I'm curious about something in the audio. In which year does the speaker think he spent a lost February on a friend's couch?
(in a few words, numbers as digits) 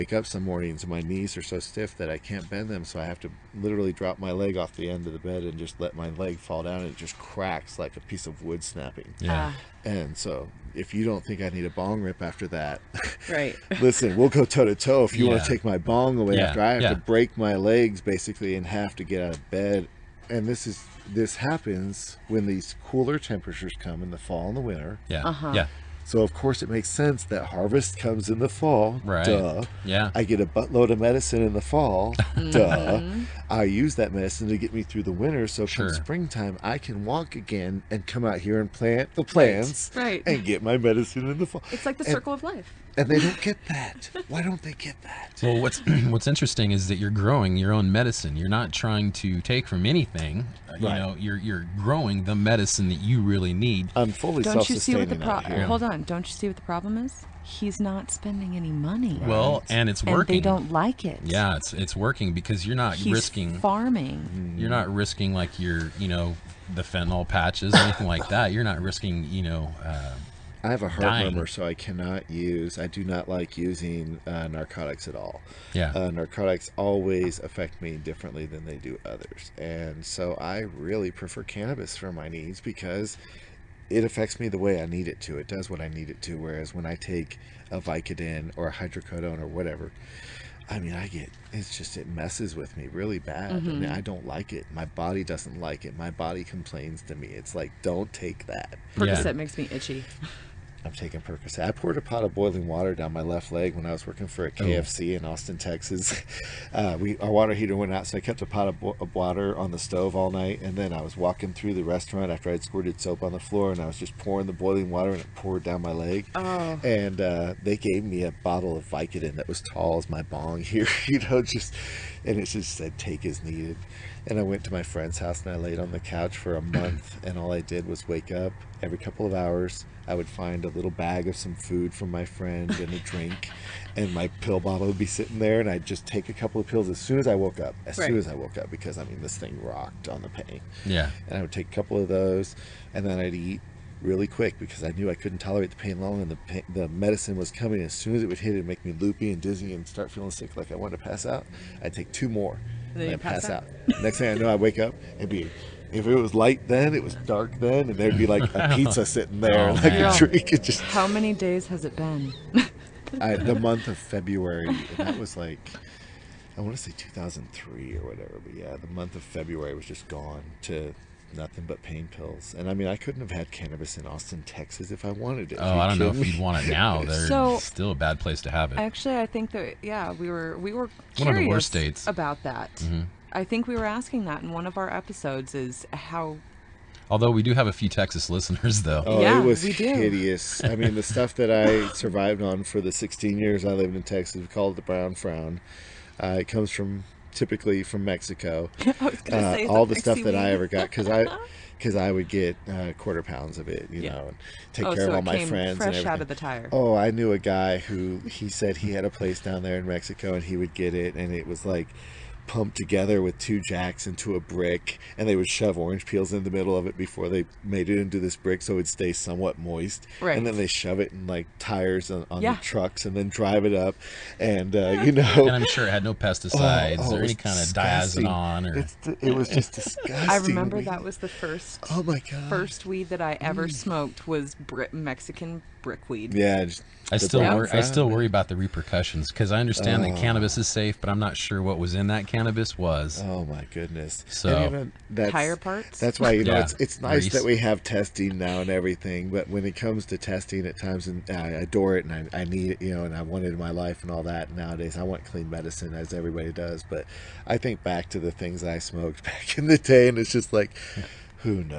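2003.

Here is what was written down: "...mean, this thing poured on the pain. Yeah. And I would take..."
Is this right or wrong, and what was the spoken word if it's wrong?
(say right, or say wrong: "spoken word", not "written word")
wrong: "rocked", not "poured".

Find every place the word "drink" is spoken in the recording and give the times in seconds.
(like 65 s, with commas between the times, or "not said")
133 s, 160 s.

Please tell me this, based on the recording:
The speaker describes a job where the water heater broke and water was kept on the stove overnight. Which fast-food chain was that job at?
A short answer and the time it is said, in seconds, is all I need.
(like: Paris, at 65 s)
KFC, at 104 s.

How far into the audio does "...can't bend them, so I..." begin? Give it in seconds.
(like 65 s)
2 s.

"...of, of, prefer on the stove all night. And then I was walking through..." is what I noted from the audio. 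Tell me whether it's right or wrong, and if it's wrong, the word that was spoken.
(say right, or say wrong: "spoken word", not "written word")
wrong: "water", not "prefer".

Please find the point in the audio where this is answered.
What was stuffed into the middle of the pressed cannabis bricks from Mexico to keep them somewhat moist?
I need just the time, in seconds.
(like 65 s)
215 s.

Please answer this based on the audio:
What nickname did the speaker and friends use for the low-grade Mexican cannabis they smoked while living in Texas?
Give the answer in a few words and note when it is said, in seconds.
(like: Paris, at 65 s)
brown frown, at 194 s.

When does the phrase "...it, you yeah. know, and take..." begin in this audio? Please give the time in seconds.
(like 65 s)
203 s.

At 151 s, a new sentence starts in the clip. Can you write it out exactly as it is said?
I'd take two more, then, pass, pass out.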